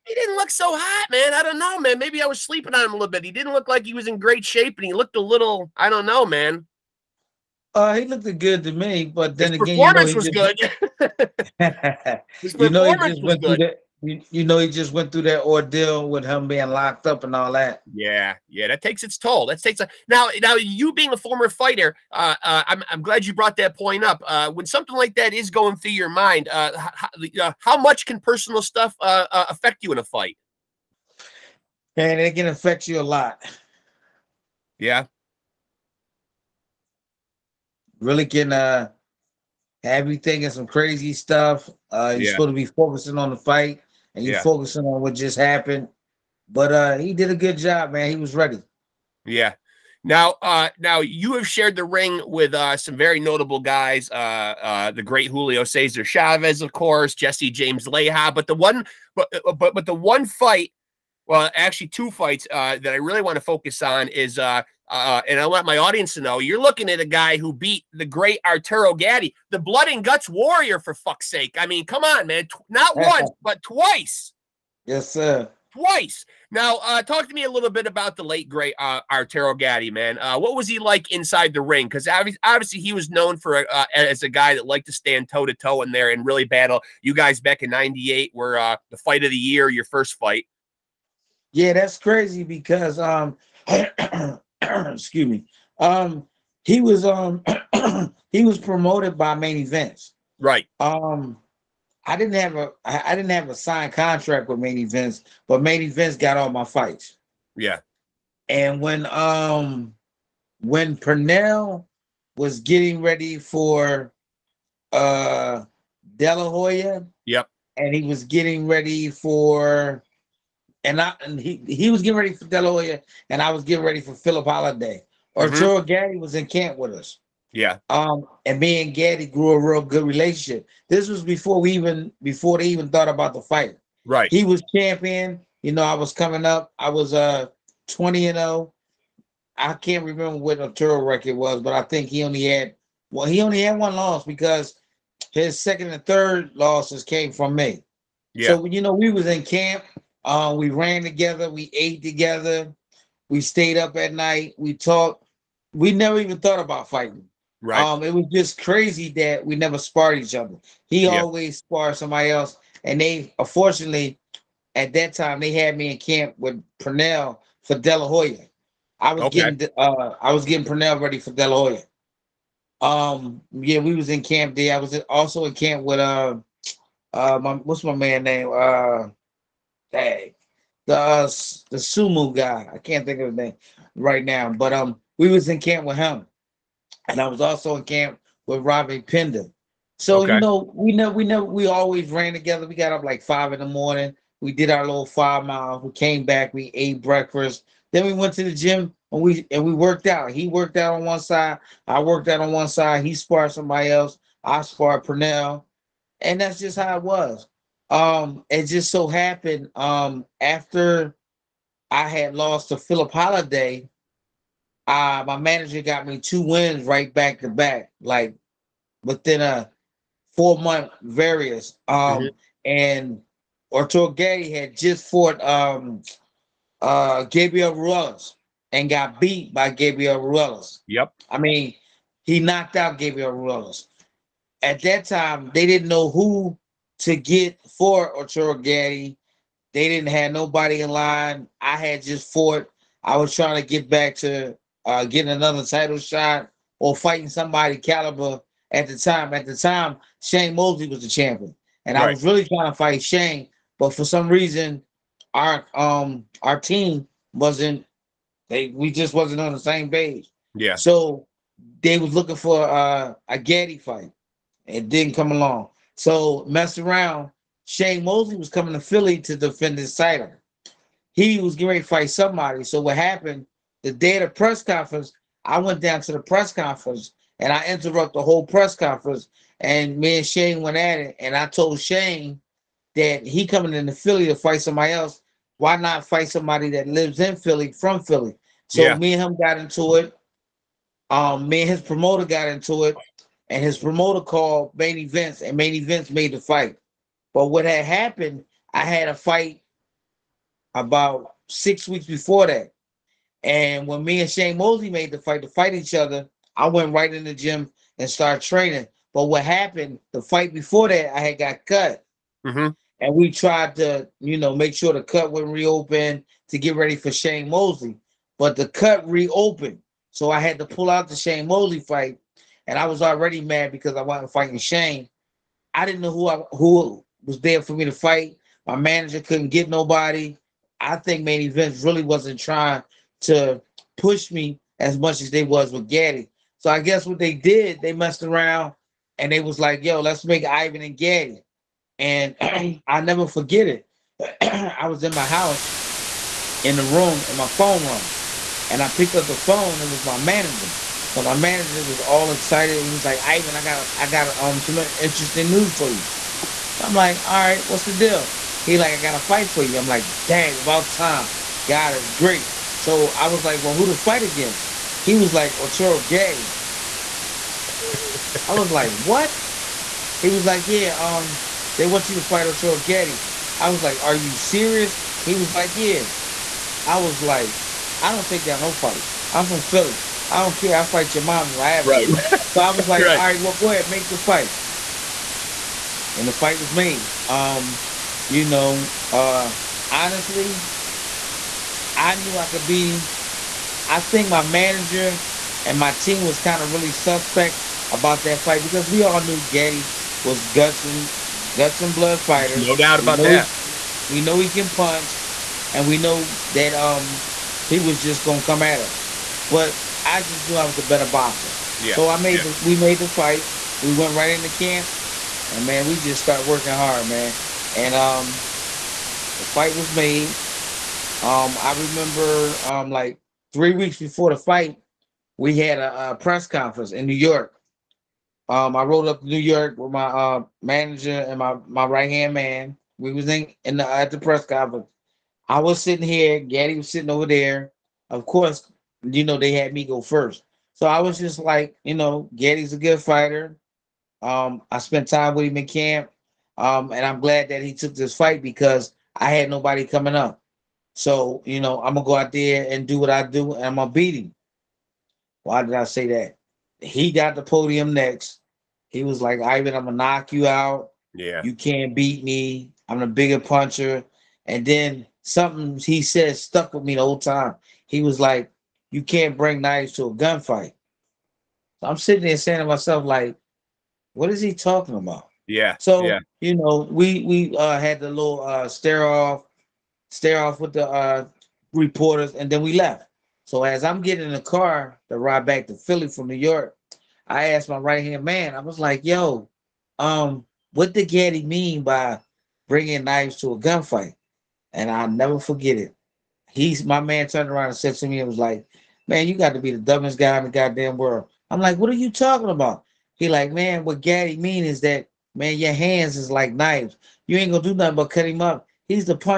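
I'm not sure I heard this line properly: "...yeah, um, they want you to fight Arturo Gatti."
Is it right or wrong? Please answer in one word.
right.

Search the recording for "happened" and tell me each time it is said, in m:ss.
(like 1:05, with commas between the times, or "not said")
0:45, 3:29, 4:32, 4:57, 5:09.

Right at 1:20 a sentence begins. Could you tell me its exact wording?
Uh, what was he like inside the ring?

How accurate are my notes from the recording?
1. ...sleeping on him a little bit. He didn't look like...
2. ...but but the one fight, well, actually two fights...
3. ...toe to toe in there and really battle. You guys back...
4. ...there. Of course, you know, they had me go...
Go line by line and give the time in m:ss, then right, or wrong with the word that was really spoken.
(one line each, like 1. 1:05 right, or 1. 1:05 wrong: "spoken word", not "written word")
1. 0:02 right
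2. 0:59 right
3. 1:25 right
4. 7:17 right.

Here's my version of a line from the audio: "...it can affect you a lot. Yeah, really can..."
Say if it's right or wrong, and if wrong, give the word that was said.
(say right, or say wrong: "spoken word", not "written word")
right.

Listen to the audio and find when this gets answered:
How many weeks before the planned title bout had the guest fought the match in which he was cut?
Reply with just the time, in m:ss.
5:01.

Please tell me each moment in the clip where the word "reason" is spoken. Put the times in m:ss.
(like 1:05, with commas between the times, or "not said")
4:14.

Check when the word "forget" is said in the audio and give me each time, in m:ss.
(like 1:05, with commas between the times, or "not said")
5:43, 8:15.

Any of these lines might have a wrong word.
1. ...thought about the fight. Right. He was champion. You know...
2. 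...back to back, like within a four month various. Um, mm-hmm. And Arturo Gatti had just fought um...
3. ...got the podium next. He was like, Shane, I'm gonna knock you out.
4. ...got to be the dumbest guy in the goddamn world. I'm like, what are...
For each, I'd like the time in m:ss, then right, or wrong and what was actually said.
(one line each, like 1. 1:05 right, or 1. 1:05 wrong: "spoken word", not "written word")
1. 2:12 right
2. 3:37 right
3. 7:37 wrong: "Ivan", not "Shane"
4. 8:19 right.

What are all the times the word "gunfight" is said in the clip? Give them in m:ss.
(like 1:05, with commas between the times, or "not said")
7:50, 8:13.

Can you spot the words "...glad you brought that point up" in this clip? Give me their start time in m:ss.
0:22.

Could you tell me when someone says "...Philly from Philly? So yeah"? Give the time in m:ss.
4:47.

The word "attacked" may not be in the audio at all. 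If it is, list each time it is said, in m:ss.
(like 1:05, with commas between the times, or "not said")
not said.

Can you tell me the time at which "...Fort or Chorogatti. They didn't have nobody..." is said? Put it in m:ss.
3:57.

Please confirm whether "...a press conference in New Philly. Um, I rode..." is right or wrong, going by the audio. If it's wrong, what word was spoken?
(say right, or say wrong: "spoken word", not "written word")
wrong: "York", not "Philly".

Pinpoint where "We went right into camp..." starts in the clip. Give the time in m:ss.
6:53.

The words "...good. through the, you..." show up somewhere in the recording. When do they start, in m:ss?
0:13.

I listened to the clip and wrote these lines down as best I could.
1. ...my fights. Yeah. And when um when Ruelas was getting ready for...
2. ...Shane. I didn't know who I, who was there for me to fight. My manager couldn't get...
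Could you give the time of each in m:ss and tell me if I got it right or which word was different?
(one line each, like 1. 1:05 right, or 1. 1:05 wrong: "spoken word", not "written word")
1. 1:46 wrong: "Purnell", not "Ruelas"
2. 5:24 right.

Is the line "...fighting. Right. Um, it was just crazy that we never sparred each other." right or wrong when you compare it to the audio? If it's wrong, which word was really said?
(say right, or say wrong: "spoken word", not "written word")
right.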